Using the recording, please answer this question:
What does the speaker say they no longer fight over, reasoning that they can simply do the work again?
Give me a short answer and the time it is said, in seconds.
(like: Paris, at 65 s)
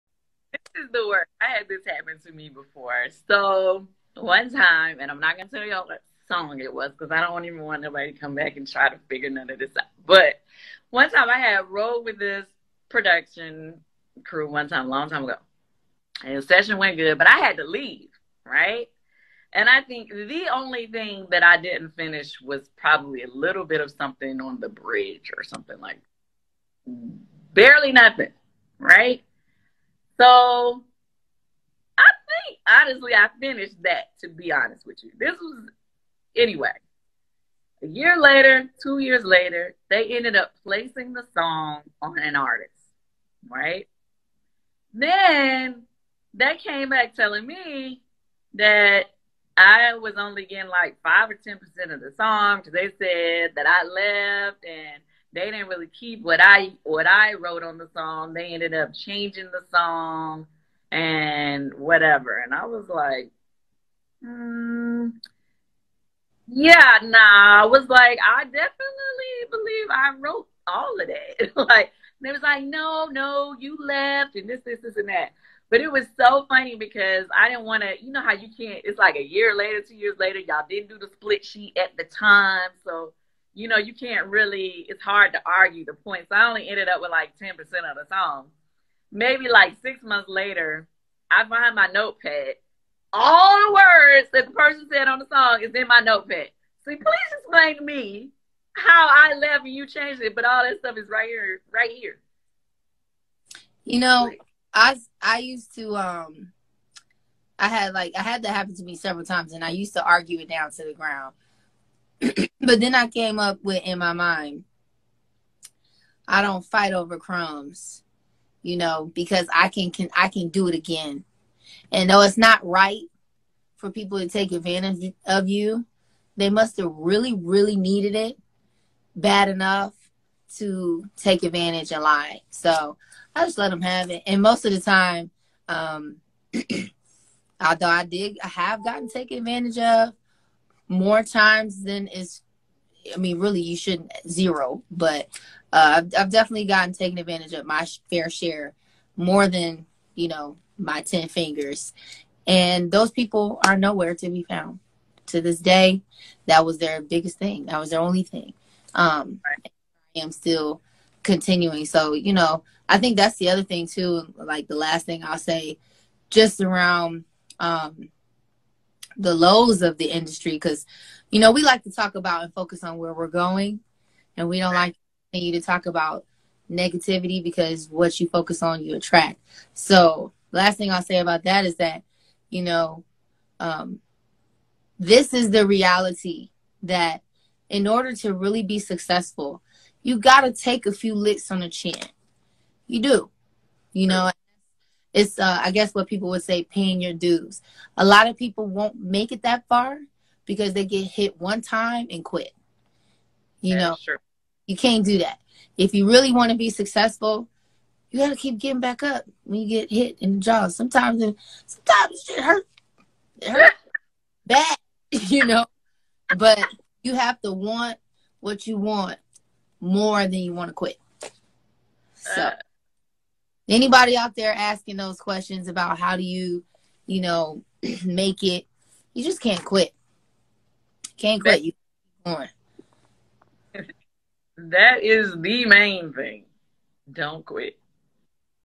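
crumbs, at 117 s.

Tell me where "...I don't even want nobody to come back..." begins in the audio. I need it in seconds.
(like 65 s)
7 s.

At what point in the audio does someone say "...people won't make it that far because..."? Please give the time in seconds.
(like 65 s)
198 s.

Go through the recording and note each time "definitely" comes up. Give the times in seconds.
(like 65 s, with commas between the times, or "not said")
68 s, 146 s.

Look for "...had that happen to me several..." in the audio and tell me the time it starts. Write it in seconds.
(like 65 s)
108 s.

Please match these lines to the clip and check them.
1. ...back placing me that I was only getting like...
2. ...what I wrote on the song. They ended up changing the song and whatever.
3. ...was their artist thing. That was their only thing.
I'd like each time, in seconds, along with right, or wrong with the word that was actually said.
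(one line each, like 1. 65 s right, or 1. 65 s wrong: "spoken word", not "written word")
1. 46 s wrong: "telling", not "placing"
2. 56 s right
3. 156 s wrong: "biggest", not "artist".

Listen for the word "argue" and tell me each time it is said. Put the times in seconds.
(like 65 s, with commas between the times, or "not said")
85 s, 110 s.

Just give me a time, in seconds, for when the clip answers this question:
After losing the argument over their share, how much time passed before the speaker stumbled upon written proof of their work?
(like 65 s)
89 s.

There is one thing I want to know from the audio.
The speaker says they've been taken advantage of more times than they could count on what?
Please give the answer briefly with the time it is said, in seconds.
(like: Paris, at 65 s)
10 fingers, at 151 s.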